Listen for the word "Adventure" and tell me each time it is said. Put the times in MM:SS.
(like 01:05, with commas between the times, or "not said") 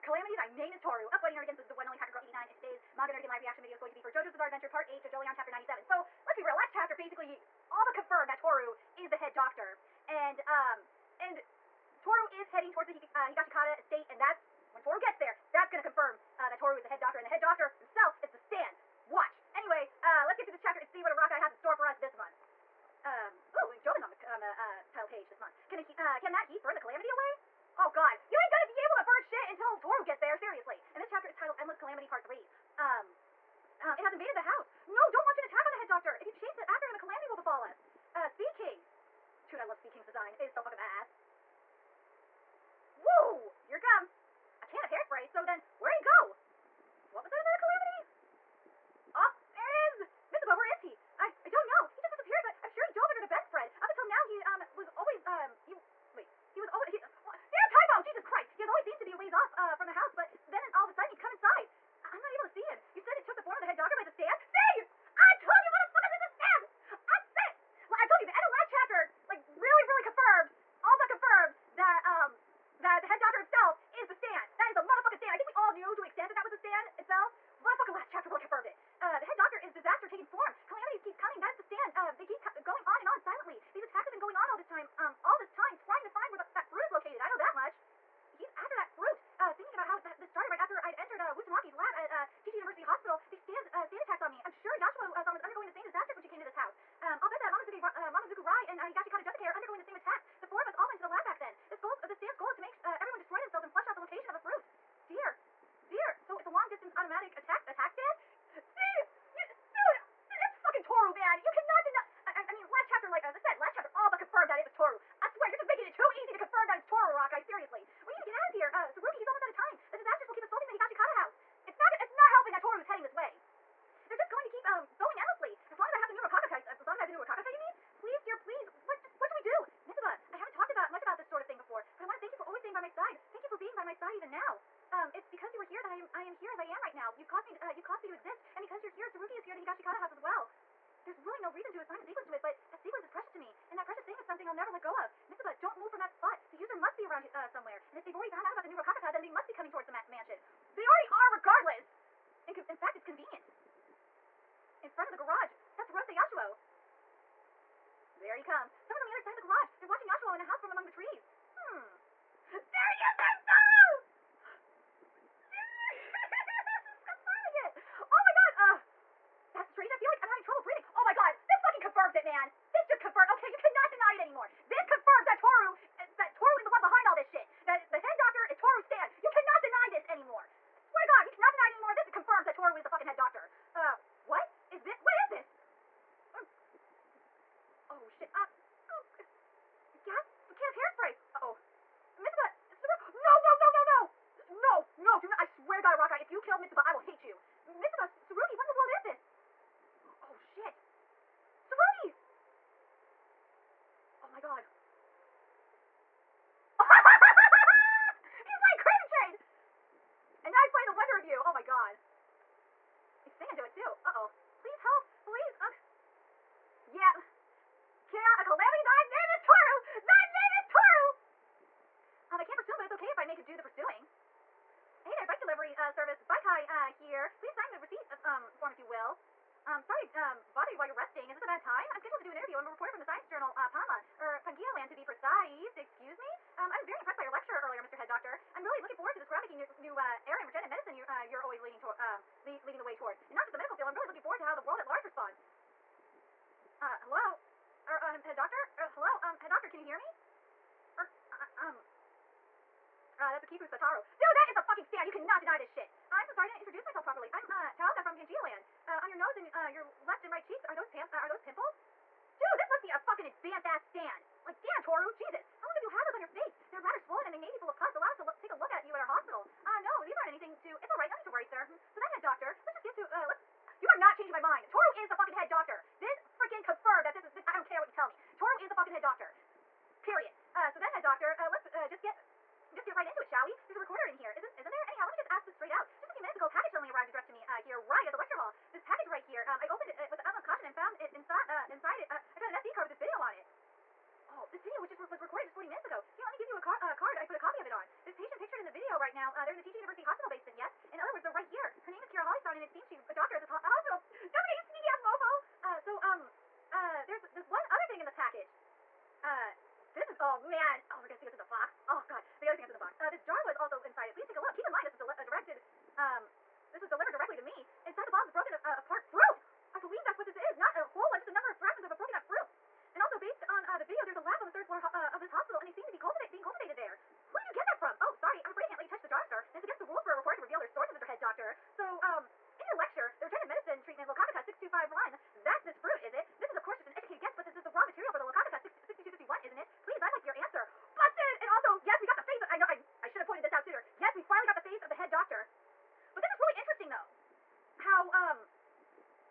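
00:04.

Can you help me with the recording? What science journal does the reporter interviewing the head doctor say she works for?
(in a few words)
Pangaea Land.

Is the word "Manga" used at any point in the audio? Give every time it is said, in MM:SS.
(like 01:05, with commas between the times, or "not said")
00:02.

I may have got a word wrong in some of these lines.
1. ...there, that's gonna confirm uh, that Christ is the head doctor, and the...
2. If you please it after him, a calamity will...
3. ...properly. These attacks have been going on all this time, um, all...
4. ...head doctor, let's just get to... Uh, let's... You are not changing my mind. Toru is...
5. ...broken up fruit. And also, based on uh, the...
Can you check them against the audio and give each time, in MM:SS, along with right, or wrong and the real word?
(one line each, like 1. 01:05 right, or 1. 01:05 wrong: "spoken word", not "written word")
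1. 00:15 wrong: "Toru", not "Christ"
2. 00:36 wrong: "chase", not "please"
3. 01:23 wrong: "silently", not "properly"
4. 04:32 right
5. 05:21 right.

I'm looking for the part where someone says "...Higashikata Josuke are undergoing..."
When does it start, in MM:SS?
01:38.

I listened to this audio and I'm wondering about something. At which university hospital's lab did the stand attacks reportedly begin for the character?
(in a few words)
Gigi University Hospital.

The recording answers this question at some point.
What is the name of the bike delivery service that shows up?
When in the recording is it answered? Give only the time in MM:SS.
03:46.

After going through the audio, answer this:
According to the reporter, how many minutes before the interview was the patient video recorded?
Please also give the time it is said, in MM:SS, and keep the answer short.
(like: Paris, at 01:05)
40, at 04:55.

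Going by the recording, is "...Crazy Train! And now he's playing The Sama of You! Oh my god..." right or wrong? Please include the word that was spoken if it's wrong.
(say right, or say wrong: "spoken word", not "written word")
wrong: "Wonder", not "Sama".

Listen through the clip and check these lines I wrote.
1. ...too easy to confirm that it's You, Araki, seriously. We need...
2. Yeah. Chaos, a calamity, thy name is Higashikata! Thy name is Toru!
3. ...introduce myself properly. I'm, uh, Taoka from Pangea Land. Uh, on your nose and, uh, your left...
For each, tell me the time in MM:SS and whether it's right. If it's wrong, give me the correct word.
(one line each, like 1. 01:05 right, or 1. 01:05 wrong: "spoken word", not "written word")
1. 01:55 wrong: "Toru", not "You"
2. 03:36 wrong: "Toru", not "Higashikata"
3. 04:16 right.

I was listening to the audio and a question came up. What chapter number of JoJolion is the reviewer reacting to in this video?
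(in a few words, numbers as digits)
97.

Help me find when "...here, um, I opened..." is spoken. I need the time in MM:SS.
04:49.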